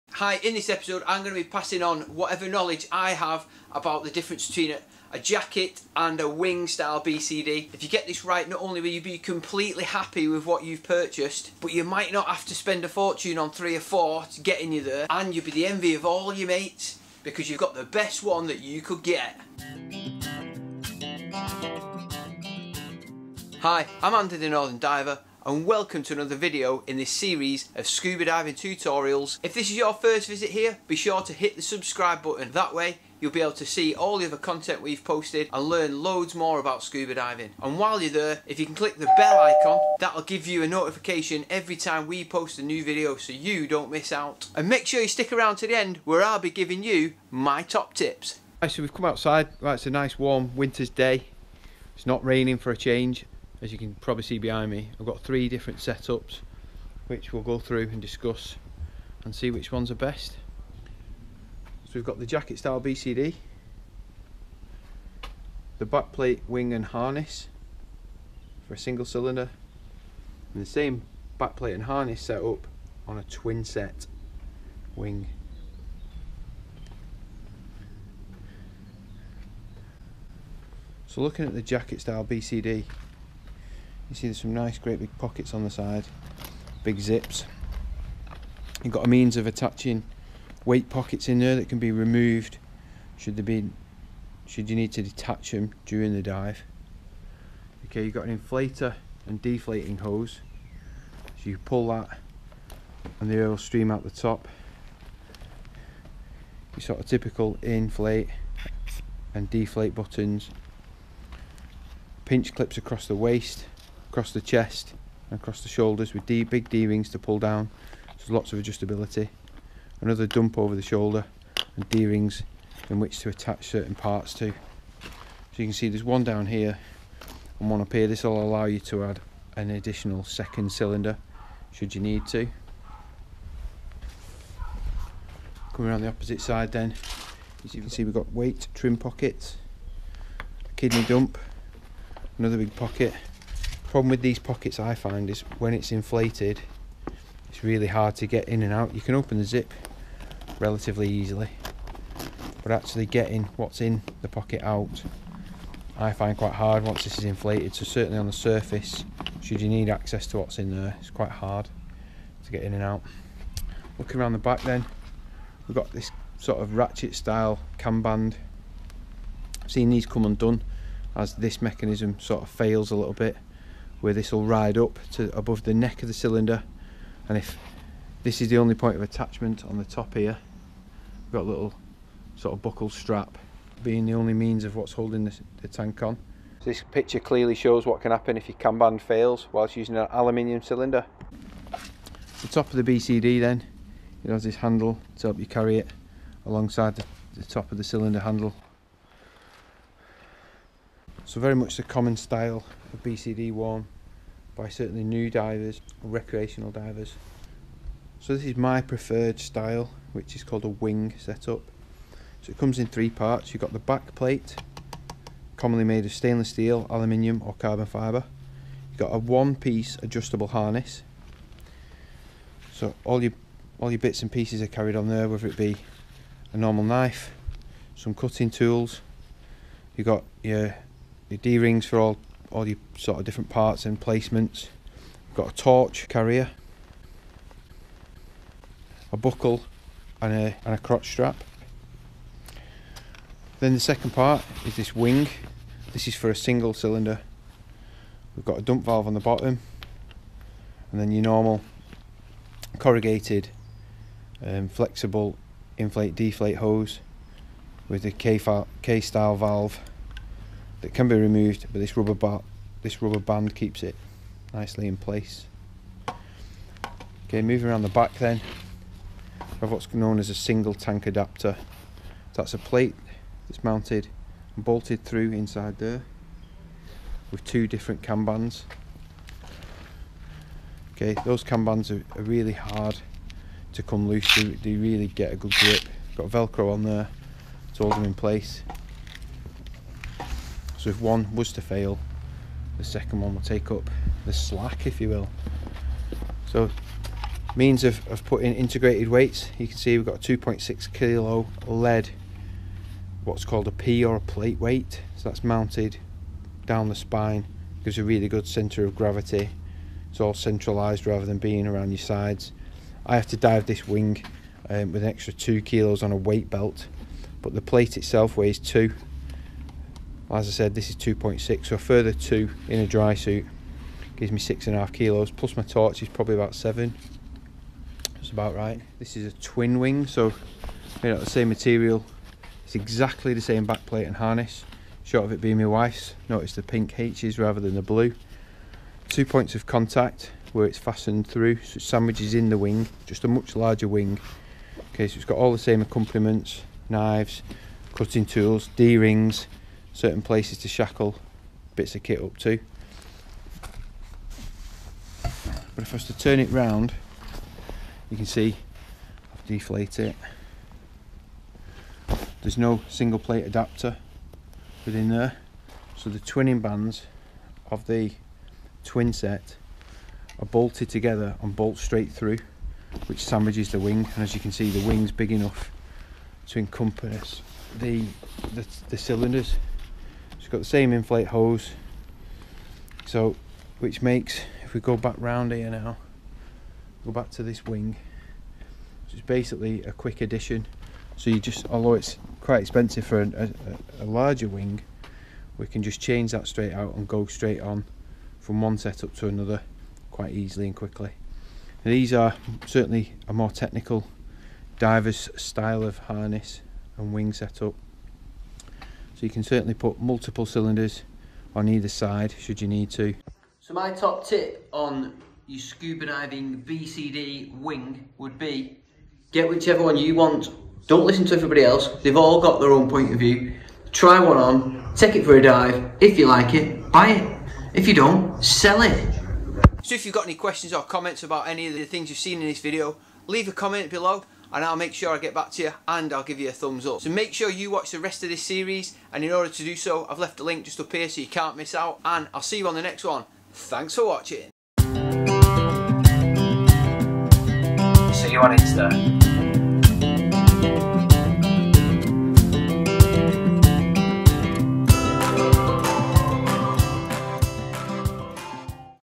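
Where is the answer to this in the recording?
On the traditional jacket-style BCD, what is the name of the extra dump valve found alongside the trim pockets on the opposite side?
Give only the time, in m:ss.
2:20.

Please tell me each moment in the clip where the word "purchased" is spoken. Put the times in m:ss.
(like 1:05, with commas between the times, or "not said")
0:10.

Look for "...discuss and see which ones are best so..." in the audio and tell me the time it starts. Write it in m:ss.
0:58.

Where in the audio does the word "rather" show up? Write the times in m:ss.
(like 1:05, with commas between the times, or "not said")
5:11, 5:37.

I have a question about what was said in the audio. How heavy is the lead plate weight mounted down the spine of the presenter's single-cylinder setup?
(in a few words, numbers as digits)
2.6 kilos.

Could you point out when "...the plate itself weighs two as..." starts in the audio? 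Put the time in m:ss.
5:17.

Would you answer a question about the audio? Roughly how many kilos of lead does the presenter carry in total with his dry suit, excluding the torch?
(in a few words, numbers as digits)
6.5 kilos.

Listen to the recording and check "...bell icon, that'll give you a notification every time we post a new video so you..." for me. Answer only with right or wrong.
right.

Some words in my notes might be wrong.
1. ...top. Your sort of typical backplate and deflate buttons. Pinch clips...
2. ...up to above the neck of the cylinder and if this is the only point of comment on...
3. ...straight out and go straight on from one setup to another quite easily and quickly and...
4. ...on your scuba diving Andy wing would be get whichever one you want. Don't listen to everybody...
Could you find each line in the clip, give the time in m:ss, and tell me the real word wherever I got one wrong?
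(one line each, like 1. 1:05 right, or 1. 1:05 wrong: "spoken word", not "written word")
1. 1:44 wrong: "inflate", not "backplate"
2. 2:54 wrong: "attachment", not "comment"
3. 6:36 right
4. 6:54 wrong: "BCD", not "Andy".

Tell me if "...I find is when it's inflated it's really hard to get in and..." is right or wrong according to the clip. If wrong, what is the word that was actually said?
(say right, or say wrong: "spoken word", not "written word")
right.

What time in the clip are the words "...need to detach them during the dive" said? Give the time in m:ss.
1:34.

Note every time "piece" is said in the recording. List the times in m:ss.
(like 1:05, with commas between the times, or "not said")
3:39, 3:44.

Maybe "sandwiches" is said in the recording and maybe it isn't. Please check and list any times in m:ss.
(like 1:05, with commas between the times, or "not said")
5:41, 6:13.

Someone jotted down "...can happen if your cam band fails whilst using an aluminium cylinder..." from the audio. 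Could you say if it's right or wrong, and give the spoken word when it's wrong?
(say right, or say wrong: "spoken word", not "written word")
right.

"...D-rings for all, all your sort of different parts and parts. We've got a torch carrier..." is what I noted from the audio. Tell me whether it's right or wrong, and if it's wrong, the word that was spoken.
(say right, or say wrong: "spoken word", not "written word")
wrong: "placements", not "parts".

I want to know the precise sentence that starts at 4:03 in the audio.
Then the second part is this wing.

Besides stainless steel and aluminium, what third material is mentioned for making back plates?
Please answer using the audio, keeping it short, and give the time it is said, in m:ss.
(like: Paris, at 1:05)
carbon fibre, at 3:37.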